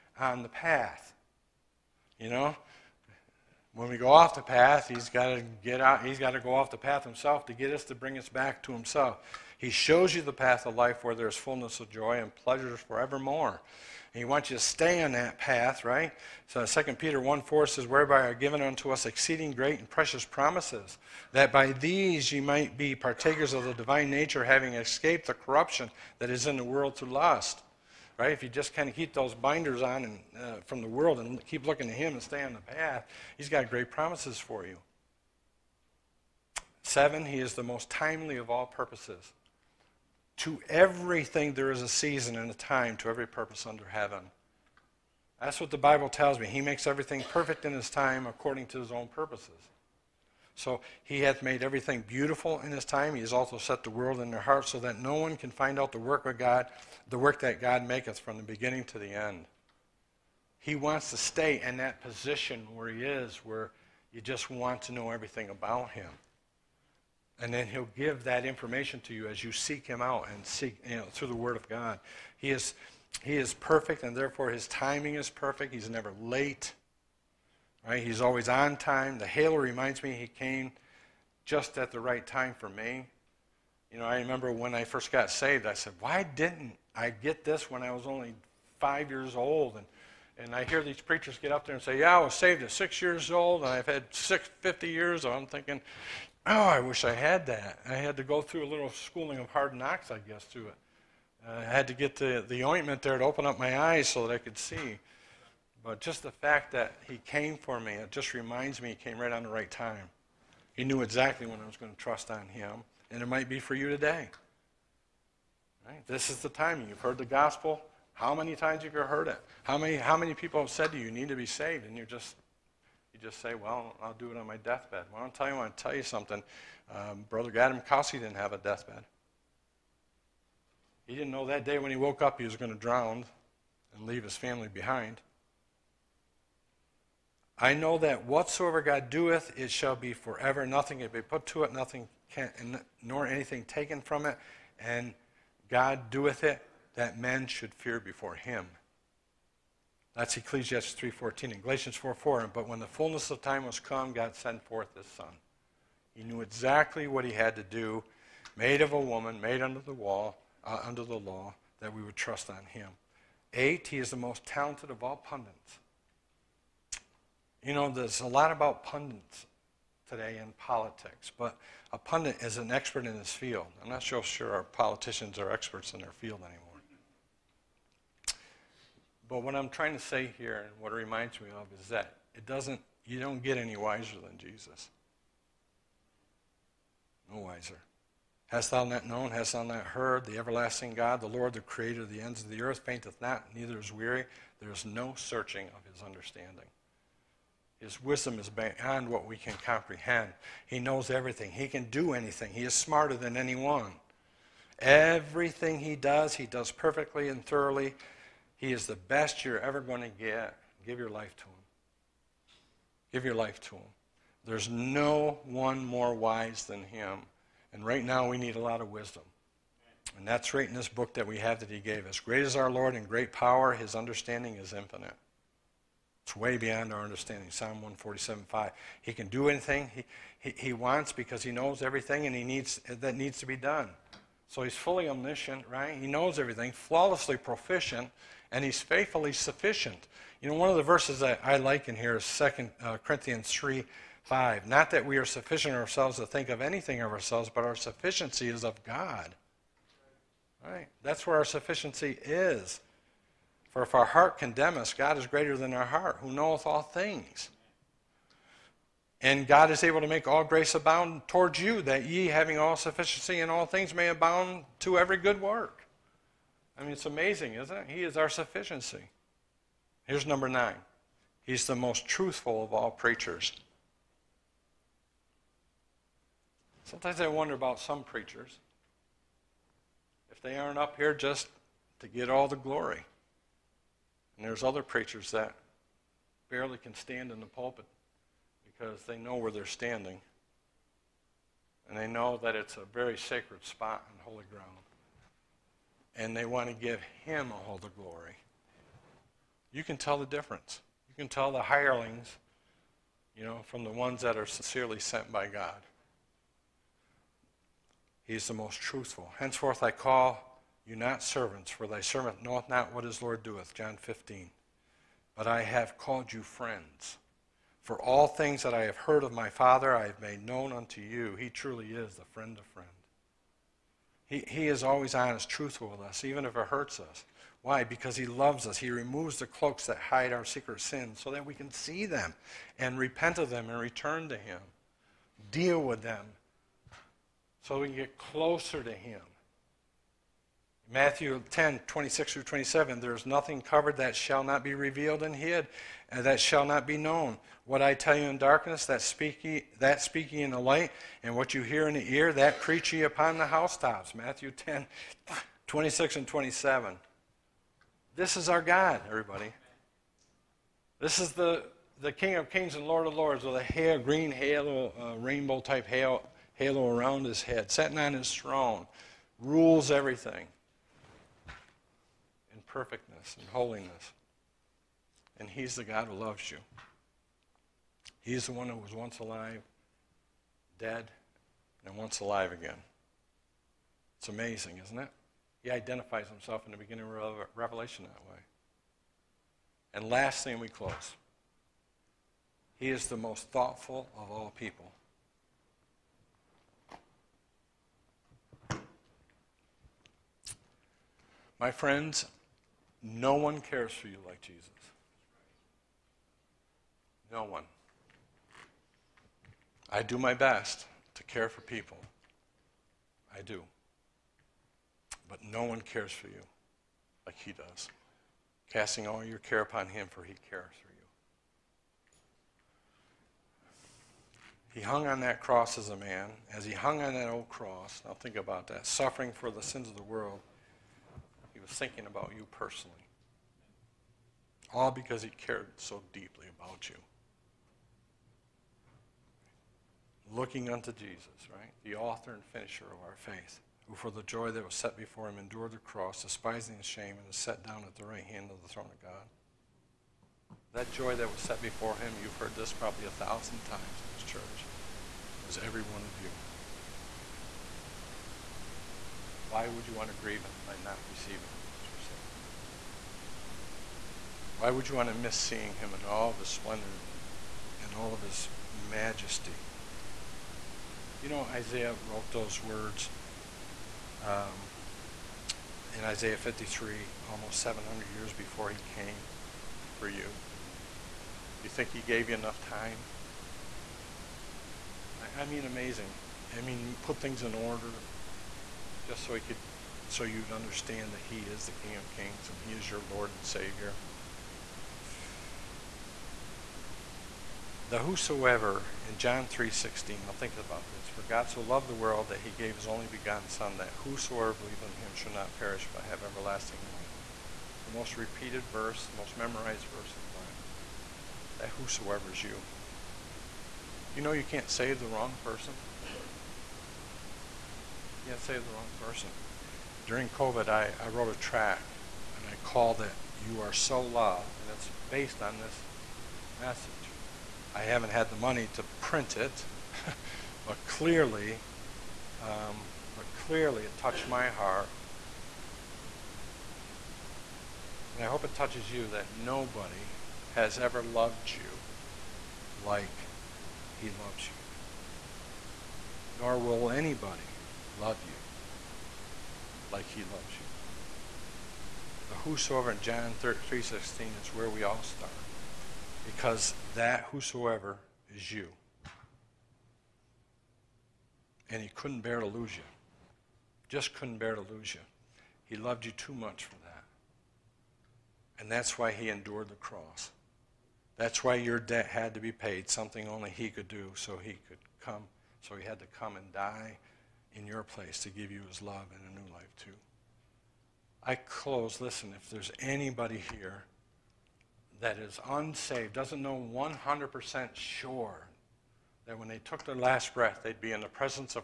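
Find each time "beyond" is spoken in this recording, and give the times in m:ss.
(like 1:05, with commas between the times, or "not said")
3:18, 3:46.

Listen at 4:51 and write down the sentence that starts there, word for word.
And they know that it's a very sacred spot and holy ground and they want to give him all the glory.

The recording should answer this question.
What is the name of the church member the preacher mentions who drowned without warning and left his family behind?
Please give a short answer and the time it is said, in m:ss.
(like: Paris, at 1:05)
Gadam Kossi, at 2:07.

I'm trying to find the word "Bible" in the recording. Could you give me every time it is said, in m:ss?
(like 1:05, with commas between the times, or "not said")
0:45, 8:30.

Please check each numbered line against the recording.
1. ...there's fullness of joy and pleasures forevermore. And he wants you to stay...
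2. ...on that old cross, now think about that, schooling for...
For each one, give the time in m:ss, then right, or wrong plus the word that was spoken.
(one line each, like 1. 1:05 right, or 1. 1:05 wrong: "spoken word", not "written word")
1. 0:11 right
2. 7:07 wrong: "suffering", not "schooling".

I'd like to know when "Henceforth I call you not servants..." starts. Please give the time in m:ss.
5:09.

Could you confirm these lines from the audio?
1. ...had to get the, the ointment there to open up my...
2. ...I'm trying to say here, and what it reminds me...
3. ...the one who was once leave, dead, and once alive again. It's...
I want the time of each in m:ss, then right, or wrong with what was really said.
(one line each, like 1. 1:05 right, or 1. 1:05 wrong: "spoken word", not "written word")
1. 1:41 right
2. 2:59 right
3. 6:18 wrong: "alive", not "leave".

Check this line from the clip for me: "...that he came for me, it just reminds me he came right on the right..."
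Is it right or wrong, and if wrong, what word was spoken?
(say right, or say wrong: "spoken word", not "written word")
right.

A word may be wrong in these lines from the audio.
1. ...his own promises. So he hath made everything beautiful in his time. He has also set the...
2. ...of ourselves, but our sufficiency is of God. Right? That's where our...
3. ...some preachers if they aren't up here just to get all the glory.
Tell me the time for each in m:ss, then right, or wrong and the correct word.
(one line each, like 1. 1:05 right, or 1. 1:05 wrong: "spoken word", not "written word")
1. 0:48 wrong: "purposes", not "promises"
2. 4:06 right
3. 4:37 right.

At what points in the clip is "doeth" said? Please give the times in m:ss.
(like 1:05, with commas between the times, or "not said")
2:19, 2:26, 5:13.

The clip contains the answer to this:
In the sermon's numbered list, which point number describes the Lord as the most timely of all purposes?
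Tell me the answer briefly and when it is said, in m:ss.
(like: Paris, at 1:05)
7, at 0:36.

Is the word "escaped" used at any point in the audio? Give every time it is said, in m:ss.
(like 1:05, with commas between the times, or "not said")
0:24.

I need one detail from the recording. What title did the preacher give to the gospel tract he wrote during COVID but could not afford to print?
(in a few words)
You Are So Loved.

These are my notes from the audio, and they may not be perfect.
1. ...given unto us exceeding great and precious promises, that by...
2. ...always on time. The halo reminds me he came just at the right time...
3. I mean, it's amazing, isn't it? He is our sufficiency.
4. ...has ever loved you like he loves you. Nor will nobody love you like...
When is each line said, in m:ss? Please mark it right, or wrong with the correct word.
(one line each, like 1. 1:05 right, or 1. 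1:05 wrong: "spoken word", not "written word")
1. 0:18 right
2. 1:18 right
3. 4:26 right
4. 9:00 wrong: "anybody", not "nobody".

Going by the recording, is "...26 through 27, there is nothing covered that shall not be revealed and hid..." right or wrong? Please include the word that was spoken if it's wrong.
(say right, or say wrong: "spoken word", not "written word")
right.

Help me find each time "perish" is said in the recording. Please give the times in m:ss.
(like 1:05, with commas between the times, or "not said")
8:25.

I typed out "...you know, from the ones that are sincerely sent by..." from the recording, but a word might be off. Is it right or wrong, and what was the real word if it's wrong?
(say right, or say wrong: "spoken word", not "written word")
right.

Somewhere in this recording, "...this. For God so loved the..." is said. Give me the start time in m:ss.
8:20.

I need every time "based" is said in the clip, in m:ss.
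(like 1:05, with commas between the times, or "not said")
8:45.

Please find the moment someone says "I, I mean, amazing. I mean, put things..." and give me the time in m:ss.
8:05.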